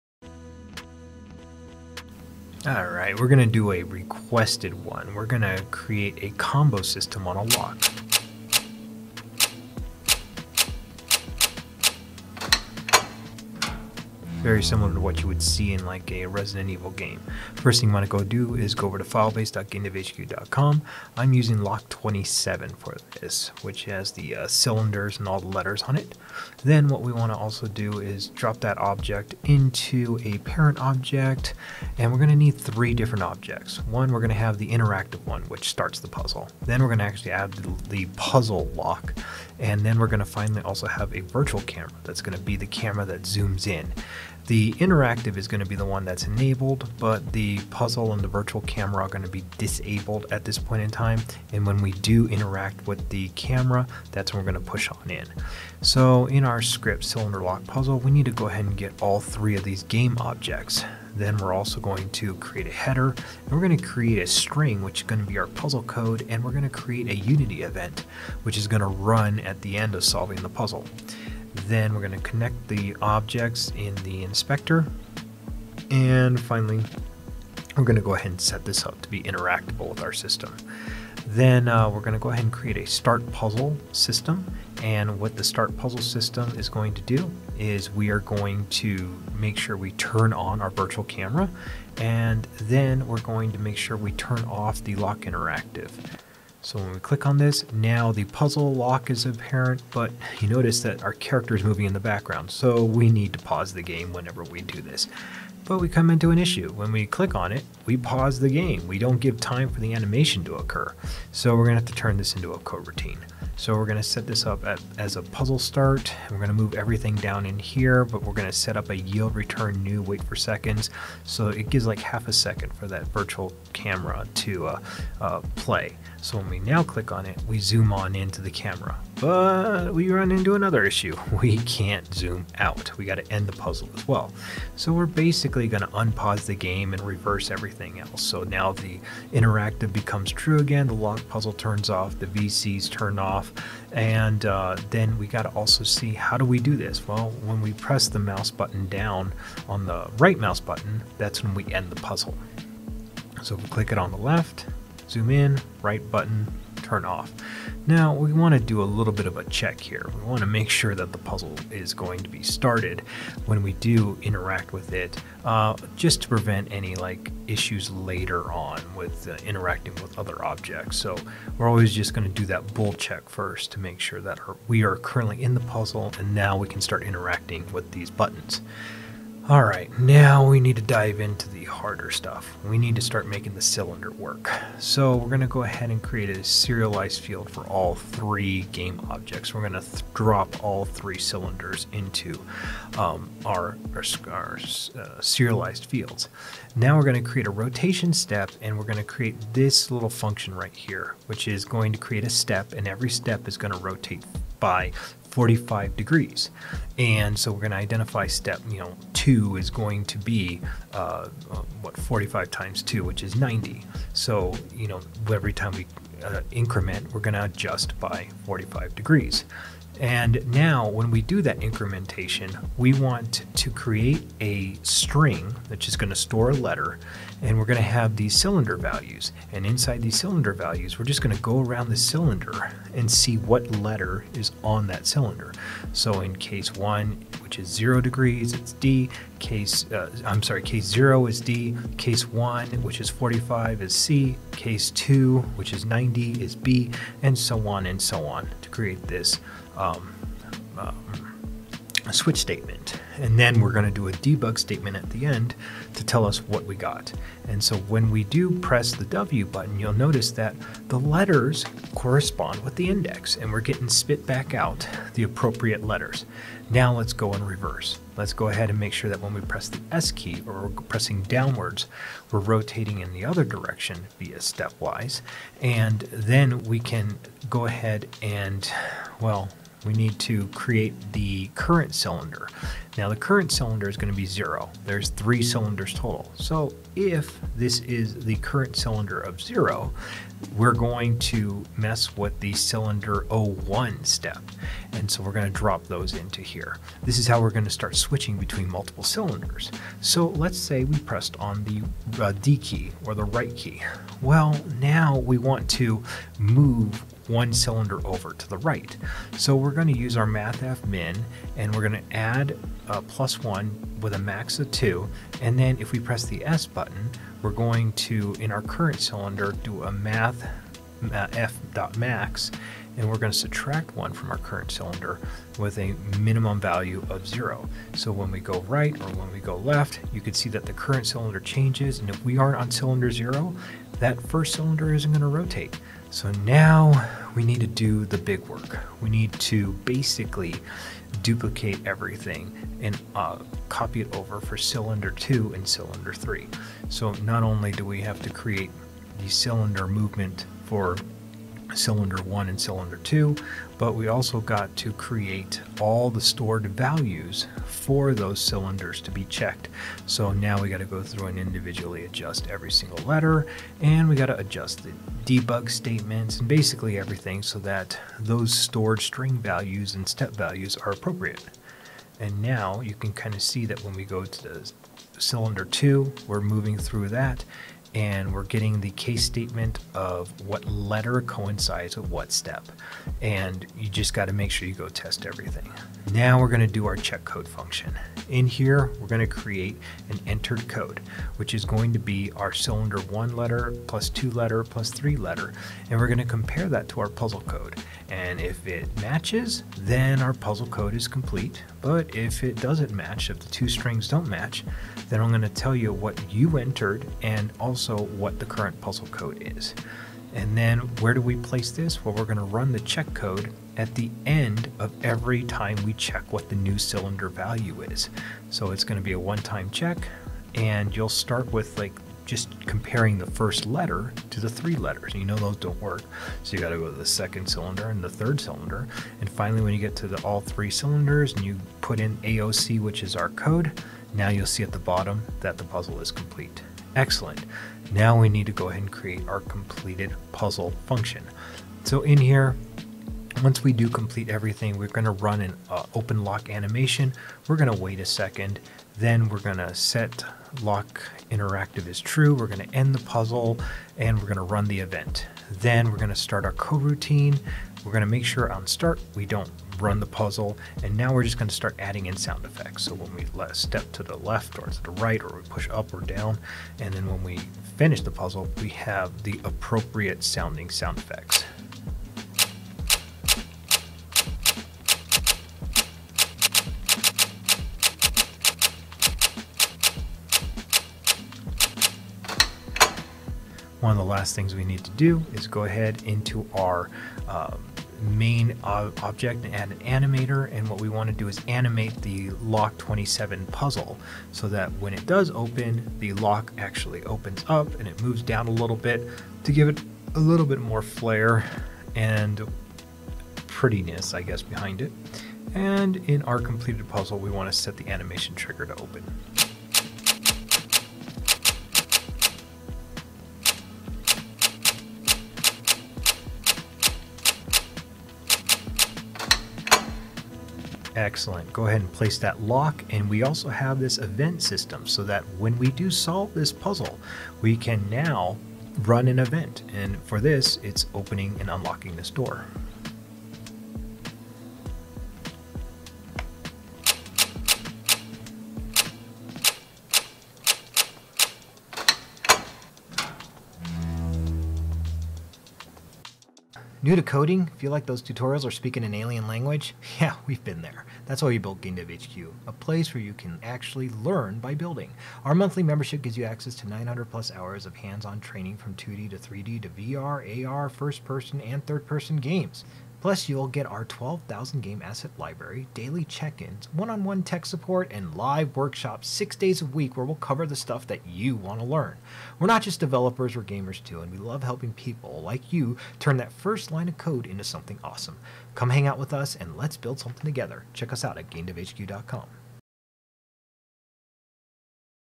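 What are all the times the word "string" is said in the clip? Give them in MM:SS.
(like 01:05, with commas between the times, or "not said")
01:04, 03:44, 06:09, 06:43.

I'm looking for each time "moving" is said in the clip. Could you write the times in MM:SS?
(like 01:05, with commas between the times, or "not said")
01:41, 06:16.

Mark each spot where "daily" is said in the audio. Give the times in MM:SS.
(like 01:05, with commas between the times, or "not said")
09:25.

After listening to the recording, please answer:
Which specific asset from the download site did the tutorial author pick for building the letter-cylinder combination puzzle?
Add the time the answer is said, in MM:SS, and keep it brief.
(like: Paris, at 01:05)
lock27, at 00:21.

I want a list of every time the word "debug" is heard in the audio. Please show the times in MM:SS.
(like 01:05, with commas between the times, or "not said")
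04:14, 06:05.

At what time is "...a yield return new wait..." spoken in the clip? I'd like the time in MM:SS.
01:58.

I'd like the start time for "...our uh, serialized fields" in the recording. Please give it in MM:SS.
03:14.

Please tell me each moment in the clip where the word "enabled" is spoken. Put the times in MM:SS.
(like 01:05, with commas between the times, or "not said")
00:46.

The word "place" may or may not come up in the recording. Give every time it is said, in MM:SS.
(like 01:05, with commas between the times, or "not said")
06:51, 08:41, 09:12.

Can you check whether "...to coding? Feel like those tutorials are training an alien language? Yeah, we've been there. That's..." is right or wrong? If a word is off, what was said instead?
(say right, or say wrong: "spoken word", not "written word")
wrong: "speaking", not "training".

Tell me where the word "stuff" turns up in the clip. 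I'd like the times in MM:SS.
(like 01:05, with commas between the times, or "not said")
03:02, 09:30.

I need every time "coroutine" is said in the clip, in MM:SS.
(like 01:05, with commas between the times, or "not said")
01:52, 07:36.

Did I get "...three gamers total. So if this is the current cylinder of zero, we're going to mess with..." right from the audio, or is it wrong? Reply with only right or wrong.
wrong.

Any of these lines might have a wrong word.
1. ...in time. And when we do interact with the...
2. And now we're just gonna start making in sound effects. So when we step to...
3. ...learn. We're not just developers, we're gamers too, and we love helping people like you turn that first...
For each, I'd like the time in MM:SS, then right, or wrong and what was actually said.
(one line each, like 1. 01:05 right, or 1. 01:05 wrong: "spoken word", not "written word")
1. 00:50 right
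2. 07:40 wrong: "adding", not "making"
3. 09:31 right.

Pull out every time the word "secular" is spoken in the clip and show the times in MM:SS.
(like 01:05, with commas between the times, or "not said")
not said.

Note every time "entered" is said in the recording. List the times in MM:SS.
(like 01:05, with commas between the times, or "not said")
06:30, 06:46.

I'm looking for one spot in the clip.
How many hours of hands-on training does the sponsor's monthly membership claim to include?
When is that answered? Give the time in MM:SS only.
09:16.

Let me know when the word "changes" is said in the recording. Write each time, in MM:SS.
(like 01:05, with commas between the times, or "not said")
05:31.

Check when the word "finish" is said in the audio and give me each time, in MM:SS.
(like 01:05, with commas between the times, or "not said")
07:47.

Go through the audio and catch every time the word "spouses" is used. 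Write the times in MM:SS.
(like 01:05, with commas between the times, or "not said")
not said.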